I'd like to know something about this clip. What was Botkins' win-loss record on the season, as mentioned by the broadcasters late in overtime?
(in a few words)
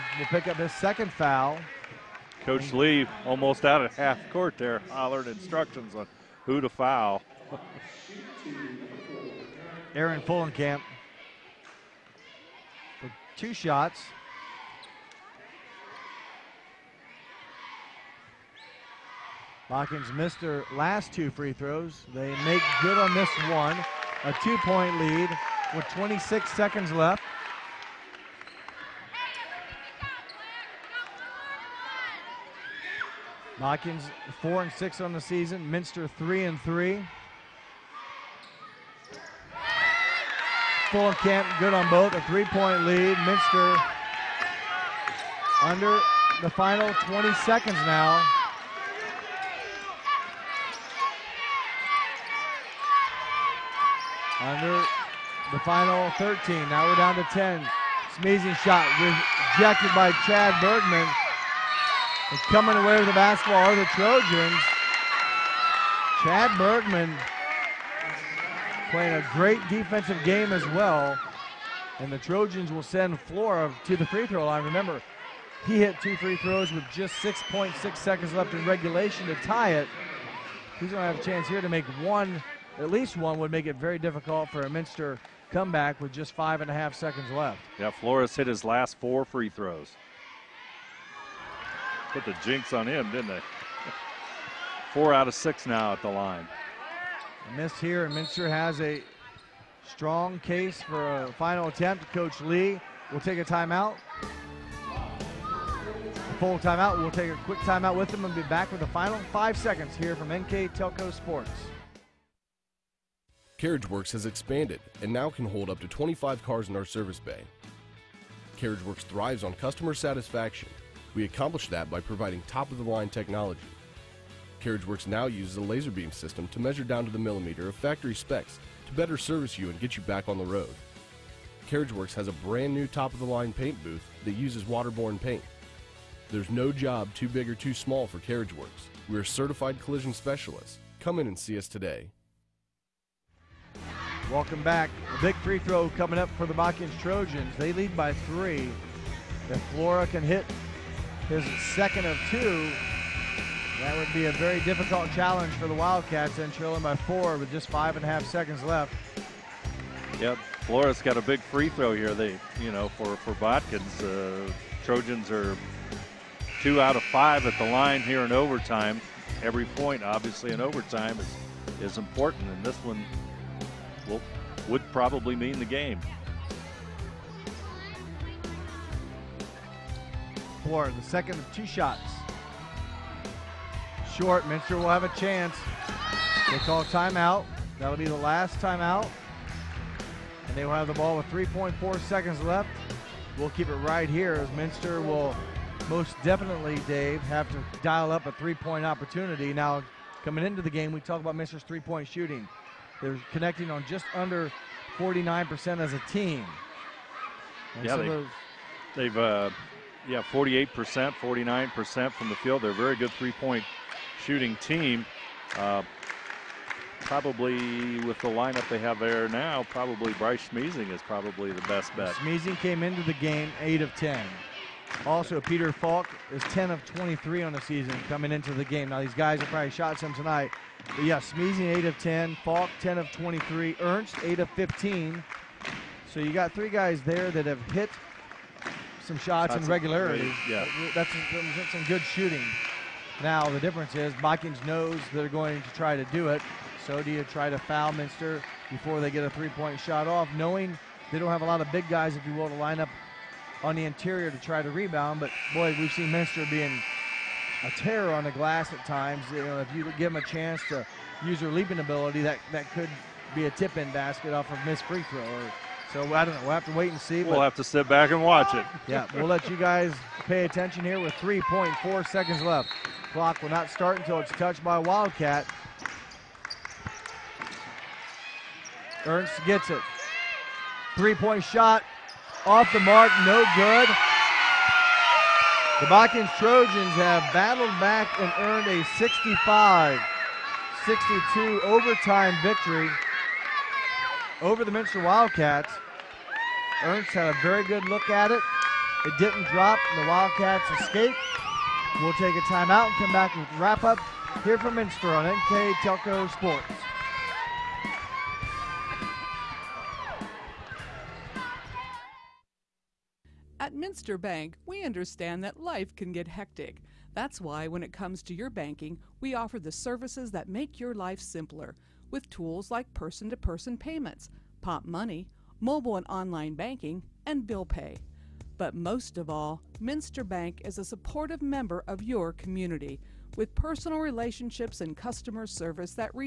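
4 and 6.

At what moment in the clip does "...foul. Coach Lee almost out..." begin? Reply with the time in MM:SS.
00:01.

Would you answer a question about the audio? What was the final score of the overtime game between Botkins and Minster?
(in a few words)
65-62.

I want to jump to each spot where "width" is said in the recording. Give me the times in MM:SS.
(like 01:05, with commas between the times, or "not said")
not said.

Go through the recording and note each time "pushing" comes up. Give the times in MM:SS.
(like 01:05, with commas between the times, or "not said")
not said.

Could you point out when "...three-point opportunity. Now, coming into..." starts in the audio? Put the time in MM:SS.
03:18.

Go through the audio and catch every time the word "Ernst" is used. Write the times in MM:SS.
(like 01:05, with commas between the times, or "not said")
03:53, 04:39, 04:56.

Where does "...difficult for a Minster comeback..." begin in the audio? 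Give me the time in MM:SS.
01:23.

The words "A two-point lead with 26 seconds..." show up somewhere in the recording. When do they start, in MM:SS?
00:24.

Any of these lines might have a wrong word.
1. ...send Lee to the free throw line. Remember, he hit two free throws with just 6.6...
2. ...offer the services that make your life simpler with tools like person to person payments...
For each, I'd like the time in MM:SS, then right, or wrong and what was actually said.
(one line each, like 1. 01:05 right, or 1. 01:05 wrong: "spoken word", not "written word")
1. 01:12 wrong: "Flora", not "Lee"
2. 05:19 right.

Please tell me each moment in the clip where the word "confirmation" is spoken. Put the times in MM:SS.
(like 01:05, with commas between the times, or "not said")
not said.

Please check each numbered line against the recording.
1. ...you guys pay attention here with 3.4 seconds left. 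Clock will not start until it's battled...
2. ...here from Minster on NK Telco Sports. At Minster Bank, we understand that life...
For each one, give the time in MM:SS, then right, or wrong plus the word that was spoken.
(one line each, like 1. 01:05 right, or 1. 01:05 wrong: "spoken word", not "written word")
1. 04:29 wrong: "touched", not "battled"
2. 05:04 right.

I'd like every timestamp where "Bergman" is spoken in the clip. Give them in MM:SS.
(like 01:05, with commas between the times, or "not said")
01:00, 01:06.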